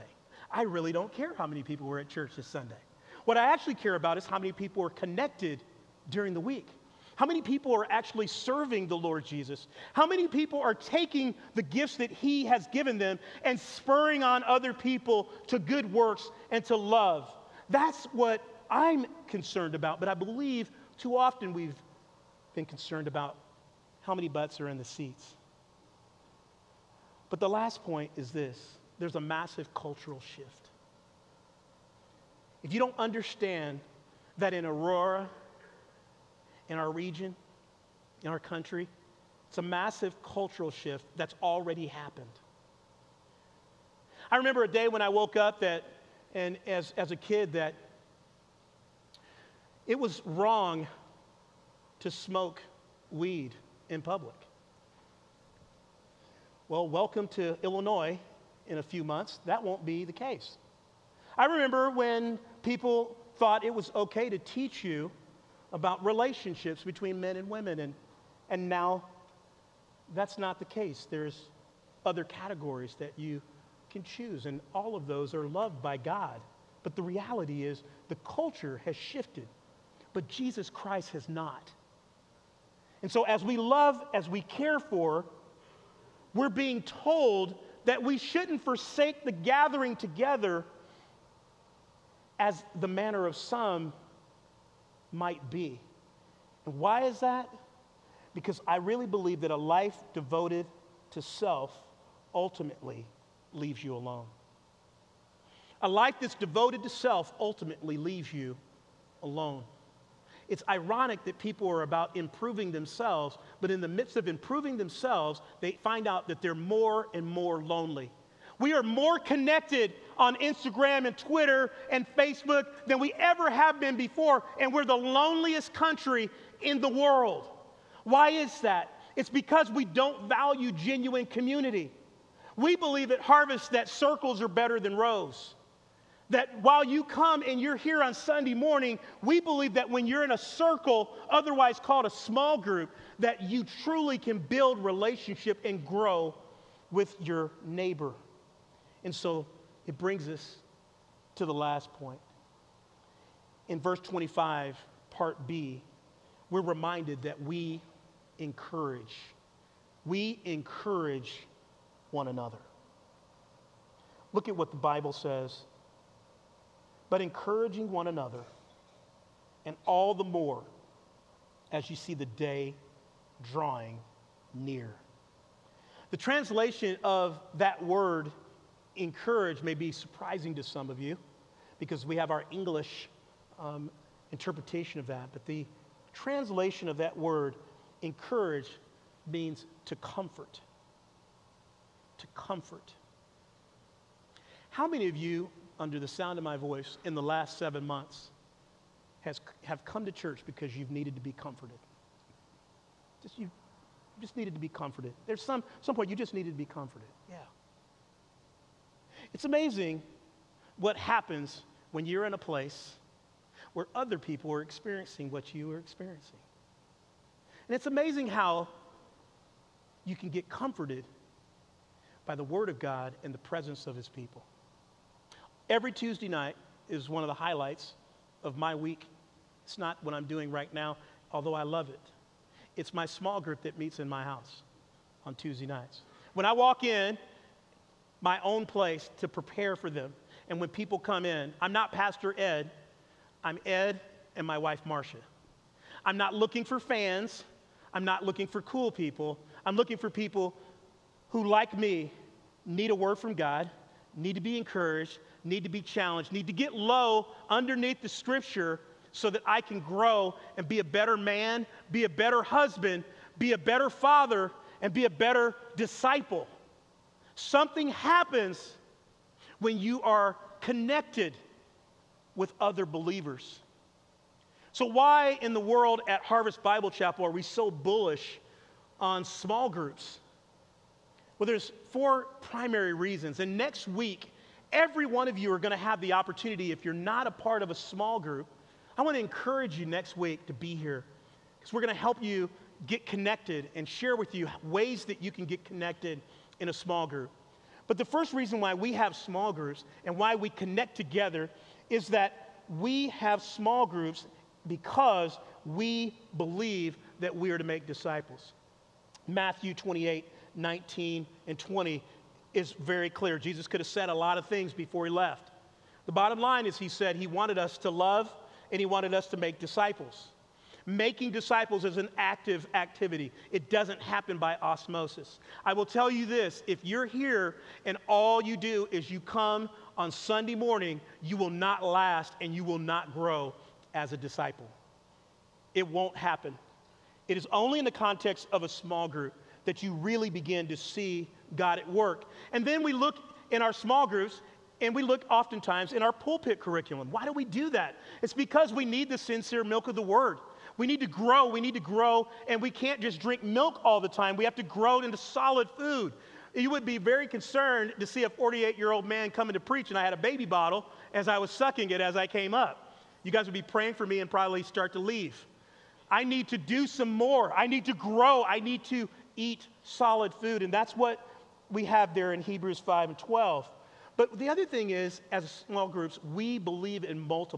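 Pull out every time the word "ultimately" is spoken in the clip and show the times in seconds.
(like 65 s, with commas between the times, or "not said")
102 s, 107 s.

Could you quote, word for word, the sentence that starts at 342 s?
And then we look in our small groups and we look oftentimes in our pulpit curriculum.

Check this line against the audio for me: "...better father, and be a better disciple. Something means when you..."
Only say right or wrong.
wrong.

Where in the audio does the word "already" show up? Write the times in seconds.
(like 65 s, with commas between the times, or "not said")
41 s.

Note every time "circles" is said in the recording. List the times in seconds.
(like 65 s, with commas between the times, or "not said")
133 s, 140 s.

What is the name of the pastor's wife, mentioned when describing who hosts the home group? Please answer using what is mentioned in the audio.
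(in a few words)
Marcia.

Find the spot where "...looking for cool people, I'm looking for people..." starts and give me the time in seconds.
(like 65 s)
248 s.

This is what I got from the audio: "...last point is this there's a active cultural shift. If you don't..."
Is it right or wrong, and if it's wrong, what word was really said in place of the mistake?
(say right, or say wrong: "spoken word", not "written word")
wrong: "massive", not "active".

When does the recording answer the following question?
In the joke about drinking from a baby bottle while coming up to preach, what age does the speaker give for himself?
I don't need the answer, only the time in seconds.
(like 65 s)
358 s.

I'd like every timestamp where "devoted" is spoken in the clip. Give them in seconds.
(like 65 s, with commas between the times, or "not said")
100 s, 106 s.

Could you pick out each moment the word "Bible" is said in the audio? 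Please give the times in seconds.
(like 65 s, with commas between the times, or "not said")
164 s, 276 s.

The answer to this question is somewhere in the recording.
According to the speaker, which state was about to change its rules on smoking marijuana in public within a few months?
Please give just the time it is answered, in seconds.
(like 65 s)
57 s.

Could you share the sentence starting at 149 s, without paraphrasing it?
And so it brings us to the last point.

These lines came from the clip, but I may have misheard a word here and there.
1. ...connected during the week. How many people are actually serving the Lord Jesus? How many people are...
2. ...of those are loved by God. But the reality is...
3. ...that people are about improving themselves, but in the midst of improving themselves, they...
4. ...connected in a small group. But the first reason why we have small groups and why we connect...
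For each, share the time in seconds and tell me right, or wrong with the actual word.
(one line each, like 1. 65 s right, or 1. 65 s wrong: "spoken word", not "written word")
1. 4 s right
2. 74 s right
3. 111 s right
4. 295 s right.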